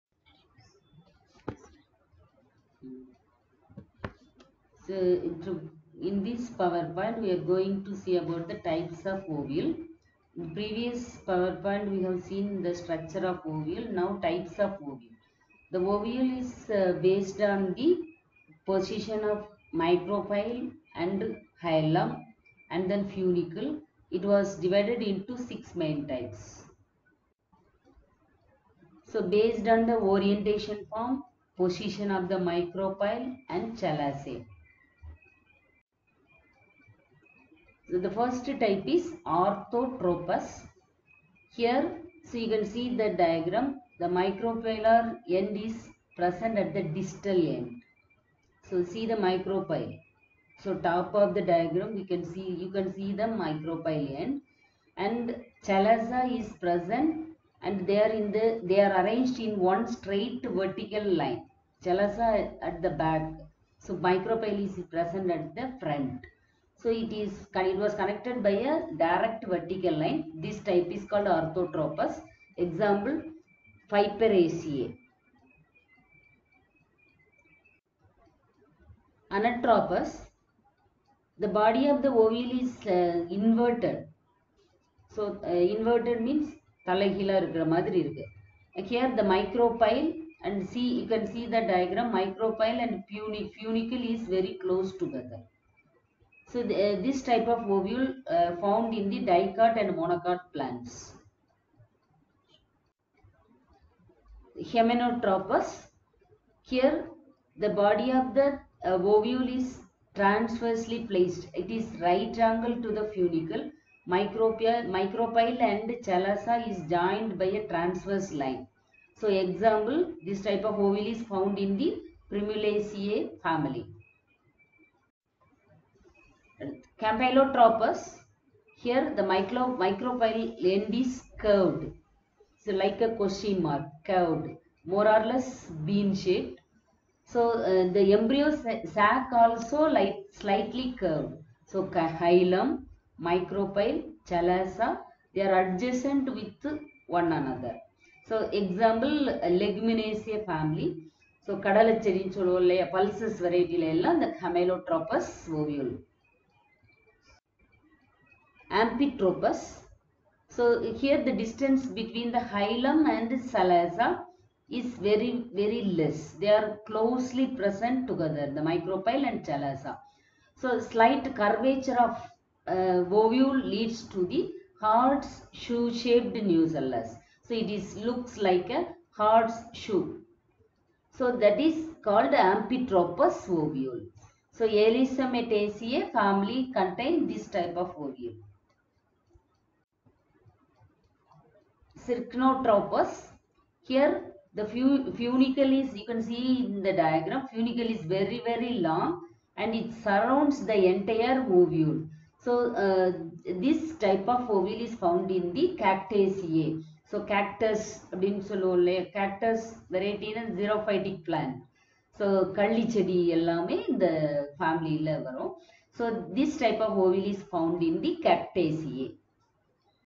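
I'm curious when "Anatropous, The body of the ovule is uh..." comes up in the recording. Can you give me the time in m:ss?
1:19.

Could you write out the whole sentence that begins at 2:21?
So hilum, micropyle, chalaza, they are adjacent with one another.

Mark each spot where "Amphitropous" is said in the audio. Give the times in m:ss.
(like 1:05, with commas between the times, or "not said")
2:38, 3:02.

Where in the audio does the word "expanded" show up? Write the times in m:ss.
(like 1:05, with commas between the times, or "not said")
not said.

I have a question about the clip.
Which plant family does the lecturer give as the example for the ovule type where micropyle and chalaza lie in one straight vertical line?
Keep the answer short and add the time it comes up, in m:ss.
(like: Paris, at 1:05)
Piperaceae, at 1:13.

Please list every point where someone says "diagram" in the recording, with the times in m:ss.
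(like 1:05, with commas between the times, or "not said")
0:43, 0:51, 1:31, 3:16.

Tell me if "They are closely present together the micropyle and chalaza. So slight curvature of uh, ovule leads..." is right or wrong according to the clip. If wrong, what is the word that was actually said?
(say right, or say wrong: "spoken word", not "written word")
right.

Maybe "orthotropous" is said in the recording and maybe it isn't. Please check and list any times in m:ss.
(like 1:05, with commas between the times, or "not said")
0:39, 1:11.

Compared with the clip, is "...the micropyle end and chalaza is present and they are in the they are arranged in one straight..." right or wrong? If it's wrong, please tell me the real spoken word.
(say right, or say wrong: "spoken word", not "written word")
right.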